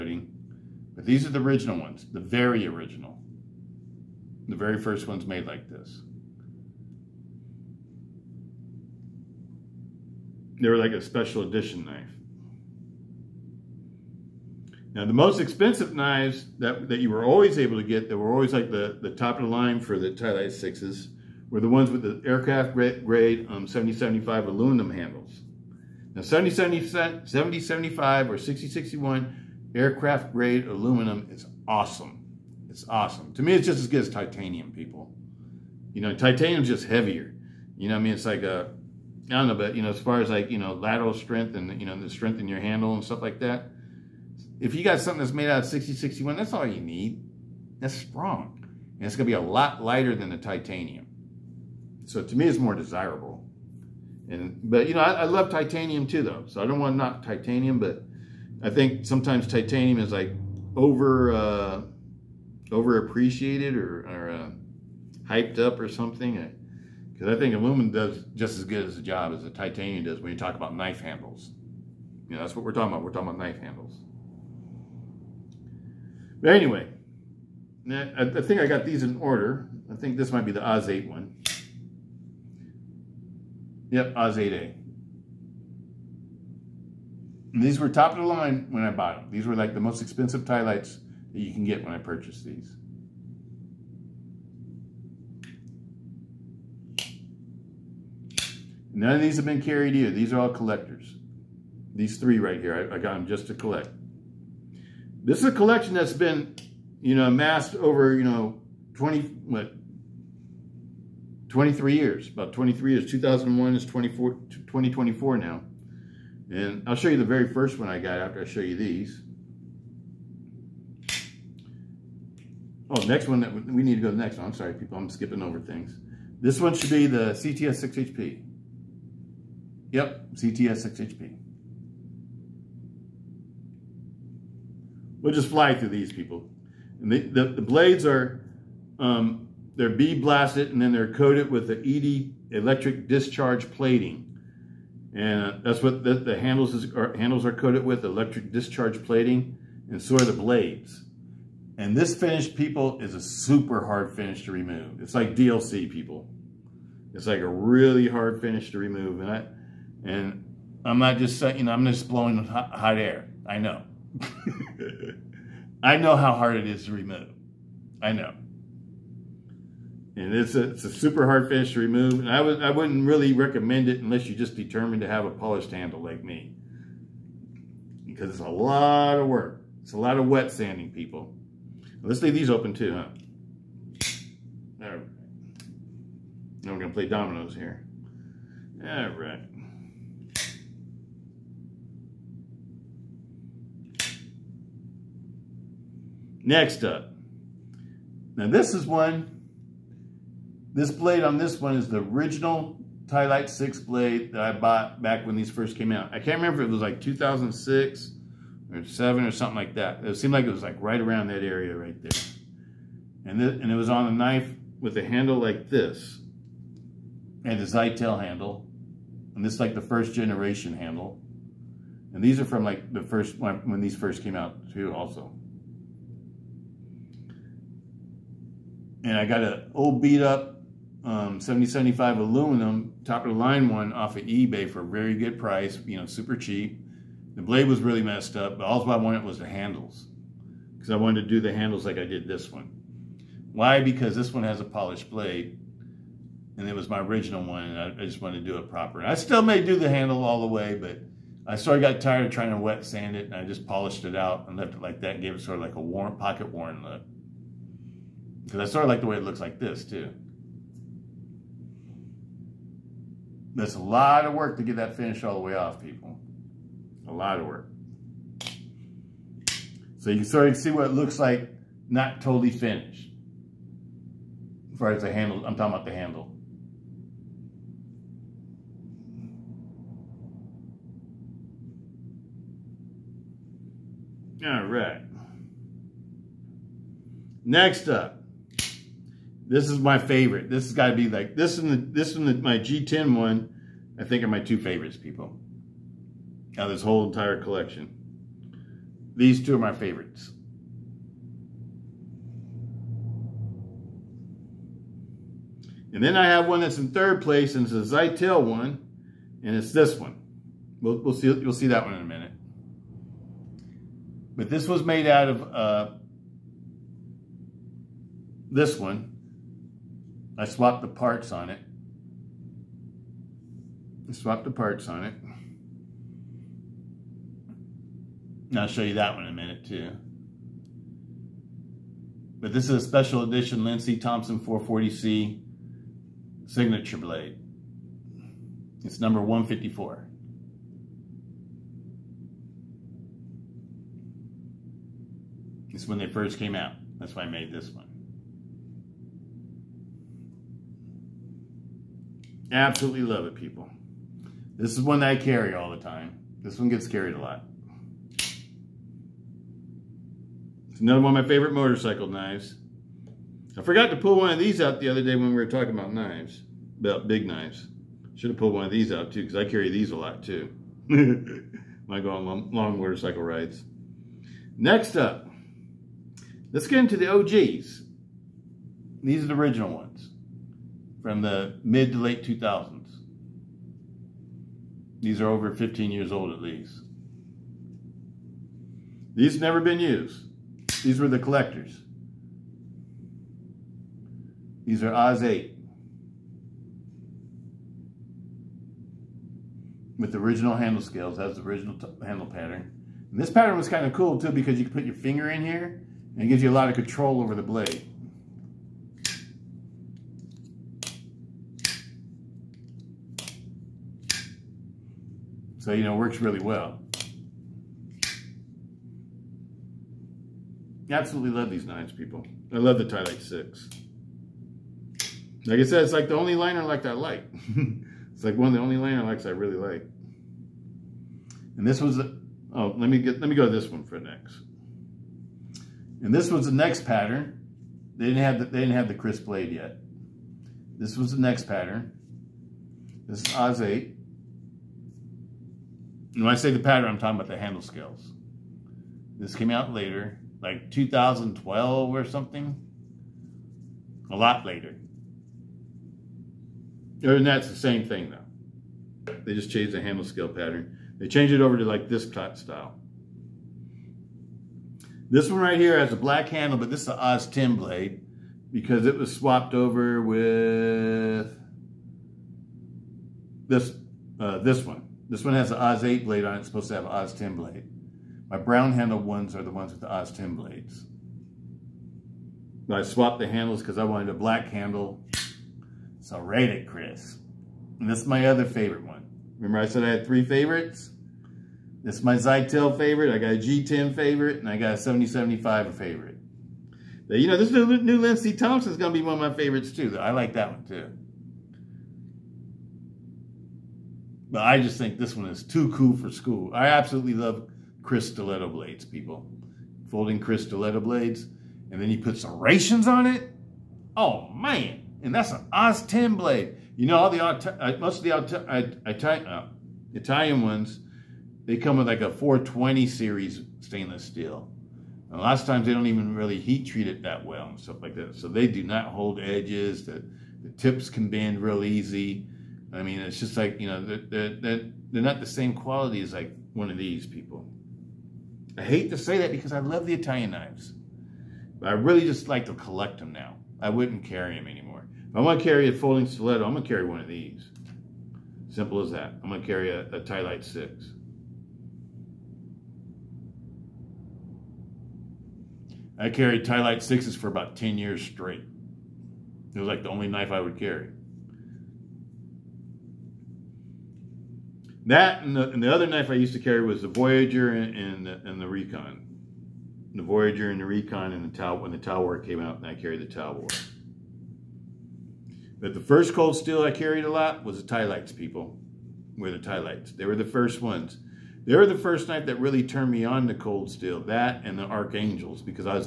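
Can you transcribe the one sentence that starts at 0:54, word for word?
And But, you know, I, I love titanium too, though.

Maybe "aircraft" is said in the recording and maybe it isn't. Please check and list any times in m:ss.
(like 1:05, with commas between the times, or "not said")
0:22, 0:29.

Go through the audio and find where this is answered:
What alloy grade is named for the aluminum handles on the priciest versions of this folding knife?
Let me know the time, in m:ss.
0:23.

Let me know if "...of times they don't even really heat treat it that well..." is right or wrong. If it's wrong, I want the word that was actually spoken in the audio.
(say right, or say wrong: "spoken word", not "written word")
right.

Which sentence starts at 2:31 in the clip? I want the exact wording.
And this finish, people, is a super hard finish to remove.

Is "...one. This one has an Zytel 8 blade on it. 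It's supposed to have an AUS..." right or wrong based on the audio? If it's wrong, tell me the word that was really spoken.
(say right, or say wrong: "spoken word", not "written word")
wrong: "AUS", not "Zytel".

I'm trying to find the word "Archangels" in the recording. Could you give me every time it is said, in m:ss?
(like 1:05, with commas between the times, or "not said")
9:44.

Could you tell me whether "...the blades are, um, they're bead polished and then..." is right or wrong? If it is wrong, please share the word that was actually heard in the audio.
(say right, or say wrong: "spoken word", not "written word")
wrong: "blasted", not "polished".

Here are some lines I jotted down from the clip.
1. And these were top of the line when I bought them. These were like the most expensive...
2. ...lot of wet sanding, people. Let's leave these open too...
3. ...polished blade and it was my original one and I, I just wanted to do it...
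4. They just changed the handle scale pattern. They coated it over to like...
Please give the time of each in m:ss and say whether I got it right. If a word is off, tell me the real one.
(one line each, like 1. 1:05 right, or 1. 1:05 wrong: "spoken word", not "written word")
1. 1:27 right
2. 2:59 right
3. 4:04 right
4. 7:39 wrong: "changed", not "coated".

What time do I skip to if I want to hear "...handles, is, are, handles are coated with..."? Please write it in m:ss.
2:26.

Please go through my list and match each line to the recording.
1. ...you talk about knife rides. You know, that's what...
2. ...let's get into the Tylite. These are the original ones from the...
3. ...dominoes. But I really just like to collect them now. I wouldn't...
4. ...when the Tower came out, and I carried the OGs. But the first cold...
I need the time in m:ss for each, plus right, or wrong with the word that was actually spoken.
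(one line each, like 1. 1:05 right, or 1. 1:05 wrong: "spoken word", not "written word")
1. 1:10 wrong: "handles", not "rides"
2. 6:16 wrong: "OGs", not "Tylite"
3. 9:00 wrong: "knives", not "dominoes"
4. 9:31 wrong: "Tower", not "OGs".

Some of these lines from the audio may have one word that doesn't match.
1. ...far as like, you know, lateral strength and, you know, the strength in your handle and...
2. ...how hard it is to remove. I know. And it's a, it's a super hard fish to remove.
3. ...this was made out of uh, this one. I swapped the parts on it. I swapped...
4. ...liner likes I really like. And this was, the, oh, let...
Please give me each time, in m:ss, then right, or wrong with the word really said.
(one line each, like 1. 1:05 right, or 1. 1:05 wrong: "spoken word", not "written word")
1. 0:40 right
2. 2:46 right
3. 5:14 right
4. 7:08 right.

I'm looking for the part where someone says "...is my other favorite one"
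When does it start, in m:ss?
8:07.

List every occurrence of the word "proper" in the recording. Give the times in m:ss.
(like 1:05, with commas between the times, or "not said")
4:08.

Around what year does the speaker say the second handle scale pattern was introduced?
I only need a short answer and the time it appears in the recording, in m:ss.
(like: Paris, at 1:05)
2012, at 7:30.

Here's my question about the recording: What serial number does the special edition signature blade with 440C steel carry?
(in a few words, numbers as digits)
154.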